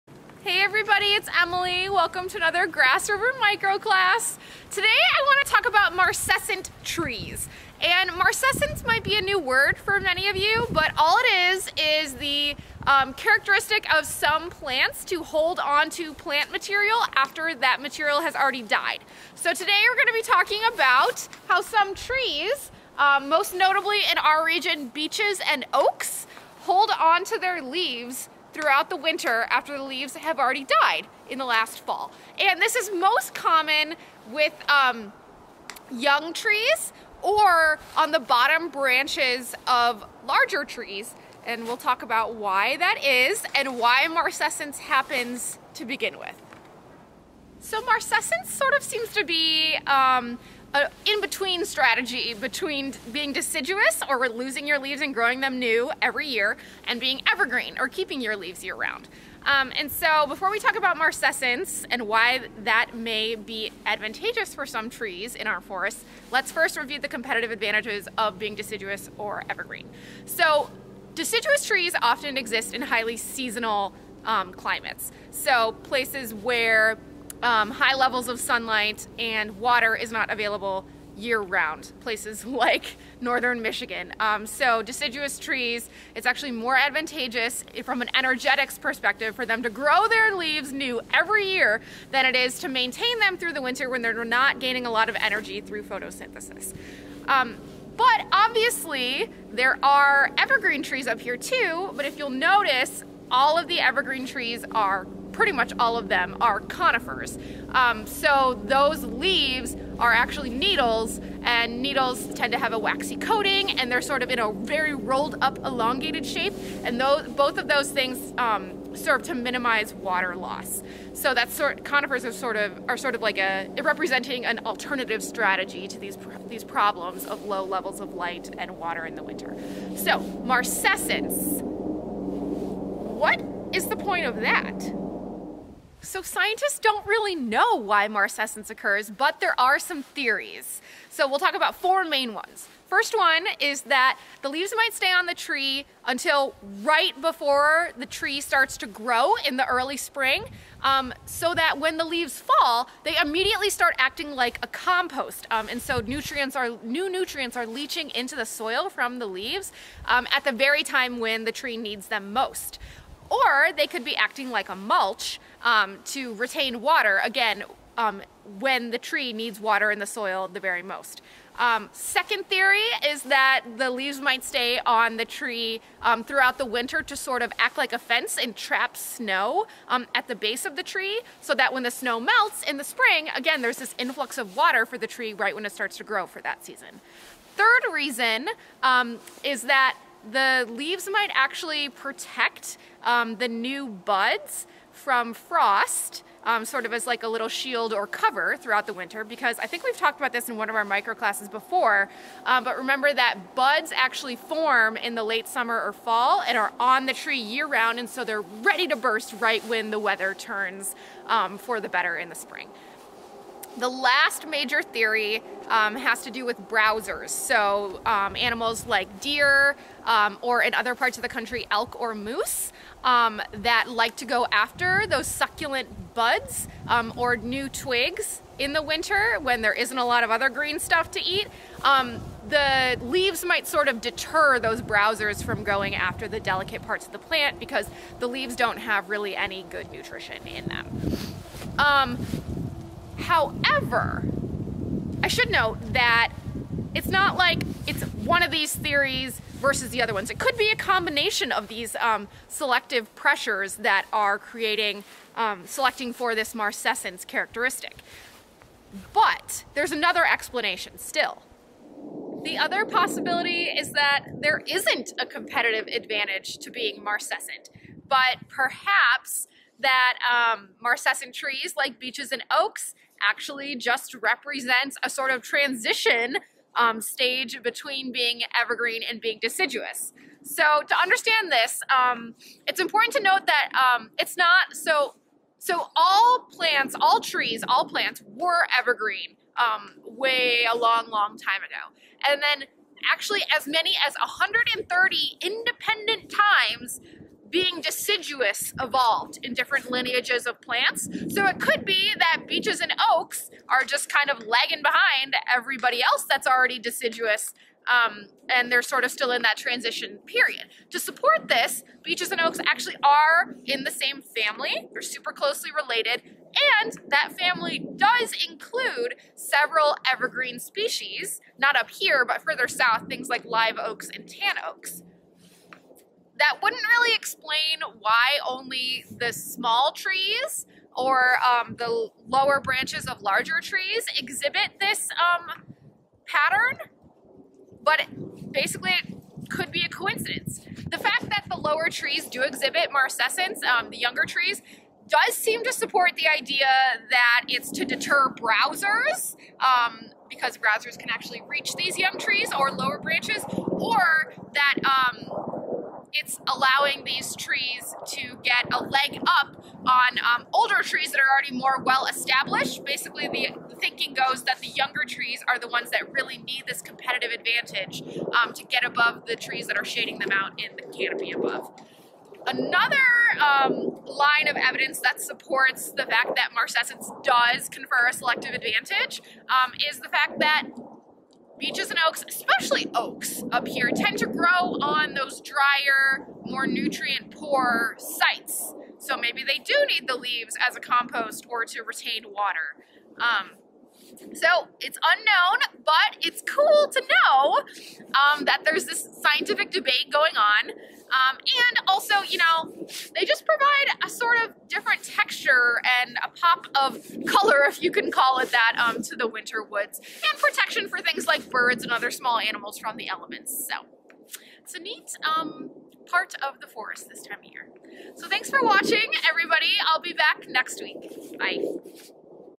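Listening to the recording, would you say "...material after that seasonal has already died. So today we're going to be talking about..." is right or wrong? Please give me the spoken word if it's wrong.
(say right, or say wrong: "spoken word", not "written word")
wrong: "material", not "seasonal".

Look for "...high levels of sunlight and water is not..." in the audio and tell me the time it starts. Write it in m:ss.
1:17.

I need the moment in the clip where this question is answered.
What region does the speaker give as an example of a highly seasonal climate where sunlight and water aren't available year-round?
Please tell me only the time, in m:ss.
1:23.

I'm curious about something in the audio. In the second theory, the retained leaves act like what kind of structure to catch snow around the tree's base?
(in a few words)
a fence.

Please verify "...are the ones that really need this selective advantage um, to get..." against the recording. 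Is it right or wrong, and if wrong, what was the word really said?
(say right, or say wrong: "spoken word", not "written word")
wrong: "competitive", not "selective".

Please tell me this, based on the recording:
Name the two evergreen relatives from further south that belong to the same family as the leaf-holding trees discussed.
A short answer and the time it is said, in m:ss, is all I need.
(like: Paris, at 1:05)
live oaks and tan oaks, at 5:23.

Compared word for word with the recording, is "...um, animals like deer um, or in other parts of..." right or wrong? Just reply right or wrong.
right.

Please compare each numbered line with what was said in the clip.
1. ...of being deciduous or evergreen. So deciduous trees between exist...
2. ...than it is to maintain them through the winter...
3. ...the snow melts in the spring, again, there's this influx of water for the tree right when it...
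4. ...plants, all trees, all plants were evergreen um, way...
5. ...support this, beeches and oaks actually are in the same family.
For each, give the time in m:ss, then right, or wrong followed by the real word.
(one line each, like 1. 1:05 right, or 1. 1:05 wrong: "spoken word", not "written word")
1. 1:08 wrong: "often", not "between"
2. 1:32 right
3. 3:01 right
4. 4:46 right
5. 5:10 right.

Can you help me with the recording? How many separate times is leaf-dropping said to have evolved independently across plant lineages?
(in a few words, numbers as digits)
130.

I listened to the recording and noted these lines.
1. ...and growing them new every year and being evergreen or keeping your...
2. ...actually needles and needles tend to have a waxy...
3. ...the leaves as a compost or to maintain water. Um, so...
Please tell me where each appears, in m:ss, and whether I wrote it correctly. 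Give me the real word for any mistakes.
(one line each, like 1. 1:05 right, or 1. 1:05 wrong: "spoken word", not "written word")
1. 0:55 right
2. 1:50 right
3. 6:30 wrong: "retain", not "maintain".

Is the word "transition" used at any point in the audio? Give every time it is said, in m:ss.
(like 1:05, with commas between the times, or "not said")
4:35, 5:09.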